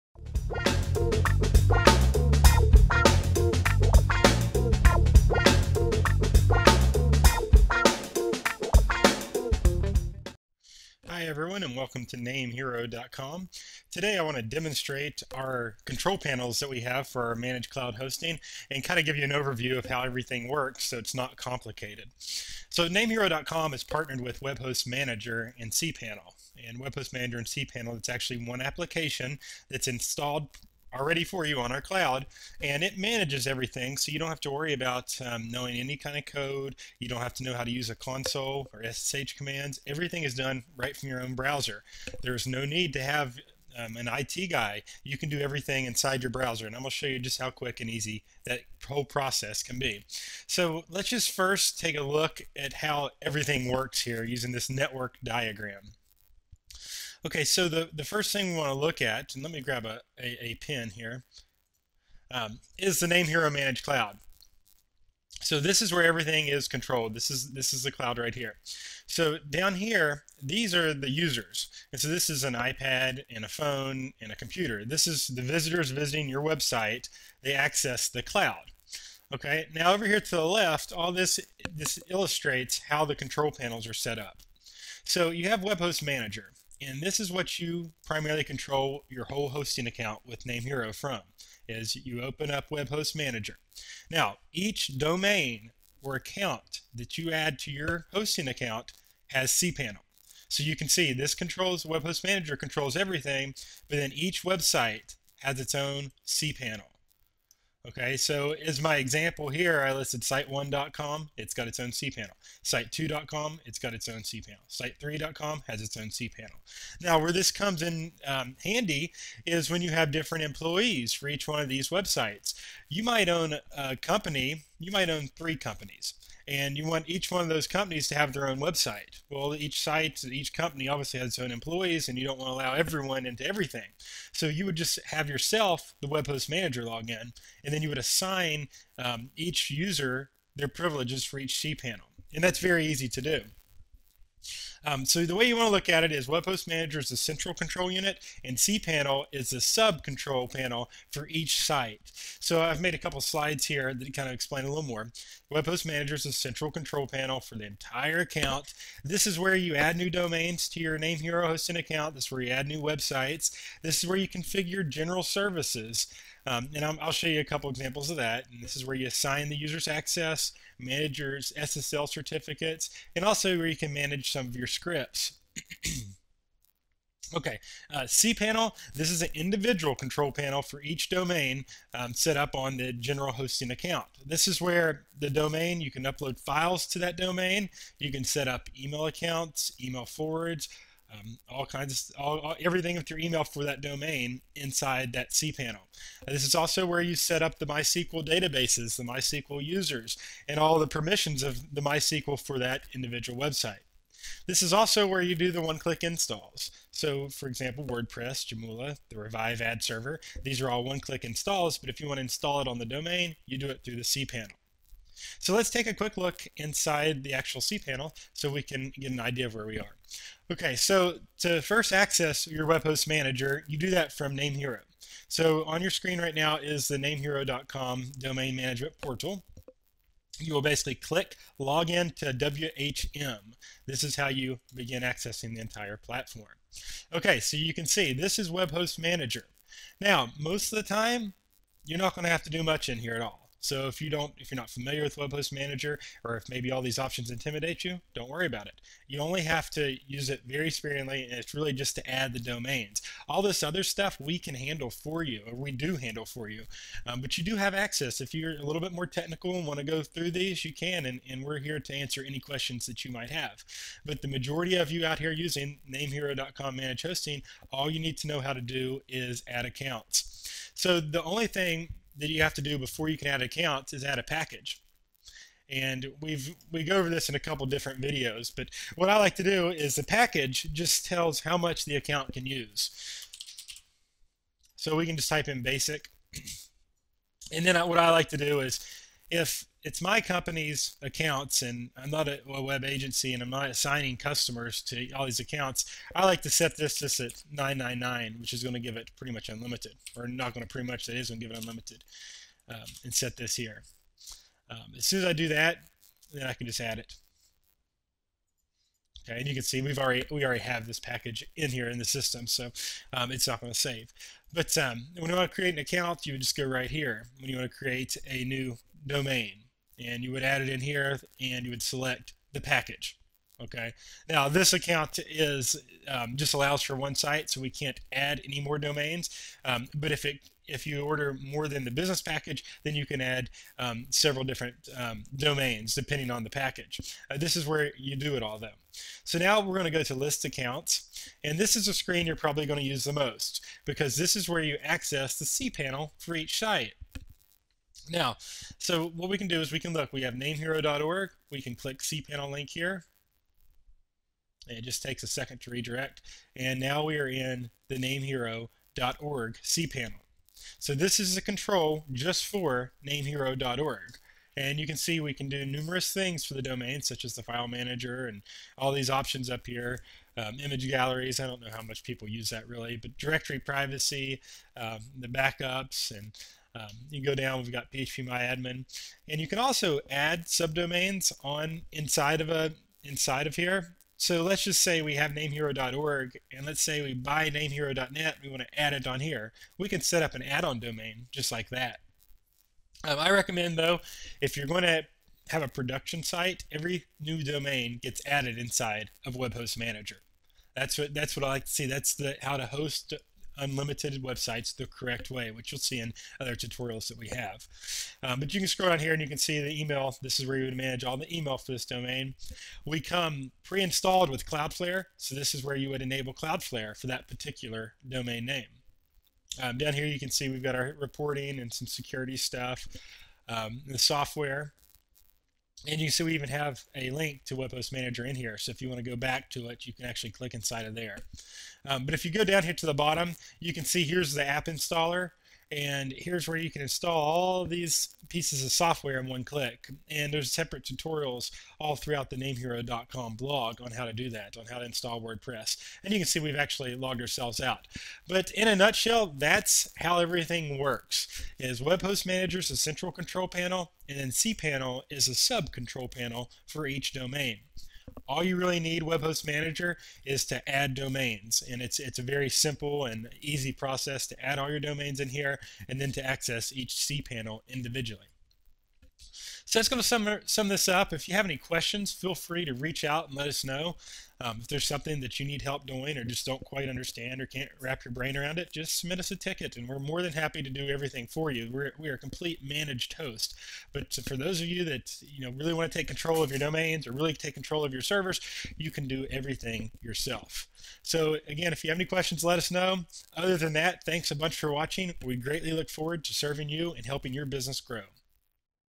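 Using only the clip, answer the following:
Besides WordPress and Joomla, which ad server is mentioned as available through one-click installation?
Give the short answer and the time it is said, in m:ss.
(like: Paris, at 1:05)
Revive, at 3:29.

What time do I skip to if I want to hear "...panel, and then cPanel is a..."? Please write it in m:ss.
7:33.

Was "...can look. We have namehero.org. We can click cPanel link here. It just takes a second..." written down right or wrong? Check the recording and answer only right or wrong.
right.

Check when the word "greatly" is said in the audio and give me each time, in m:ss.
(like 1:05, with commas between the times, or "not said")
8:15.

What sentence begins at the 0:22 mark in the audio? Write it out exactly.
So namehero.com is partnered with WebHost Manager and cPanel.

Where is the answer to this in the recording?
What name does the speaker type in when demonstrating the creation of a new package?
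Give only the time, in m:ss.
4:45.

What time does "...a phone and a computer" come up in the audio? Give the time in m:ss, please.
1:13.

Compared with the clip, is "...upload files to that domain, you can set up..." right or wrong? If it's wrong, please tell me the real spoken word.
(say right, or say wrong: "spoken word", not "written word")
right.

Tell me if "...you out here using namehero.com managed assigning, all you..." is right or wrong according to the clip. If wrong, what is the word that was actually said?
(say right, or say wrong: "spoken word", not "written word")
wrong: "hosting", not "assigning".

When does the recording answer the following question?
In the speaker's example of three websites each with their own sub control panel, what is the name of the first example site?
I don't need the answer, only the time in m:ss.
1:50.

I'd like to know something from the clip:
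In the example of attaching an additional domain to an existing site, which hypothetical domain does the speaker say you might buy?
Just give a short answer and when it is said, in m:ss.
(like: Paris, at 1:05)
namehero.net, at 6:27.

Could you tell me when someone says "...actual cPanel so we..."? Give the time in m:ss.
3:37.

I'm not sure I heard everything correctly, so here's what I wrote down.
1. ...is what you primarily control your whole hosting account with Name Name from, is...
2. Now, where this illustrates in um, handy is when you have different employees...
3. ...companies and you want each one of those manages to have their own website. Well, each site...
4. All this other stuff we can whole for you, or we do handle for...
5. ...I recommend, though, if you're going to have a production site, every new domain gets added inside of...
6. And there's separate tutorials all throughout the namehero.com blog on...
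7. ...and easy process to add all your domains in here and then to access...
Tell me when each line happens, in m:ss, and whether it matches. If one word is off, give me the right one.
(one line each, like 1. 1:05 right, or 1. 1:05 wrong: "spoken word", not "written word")
1. 1:27 wrong: "Hero", not "Name"
2. 1:57 wrong: "comes", not "illustrates"
3. 2:05 wrong: "companies", not "manages"
4. 4:13 wrong: "handle", not "whole"
5. 6:33 right
6. 7:20 right
7. 7:43 right.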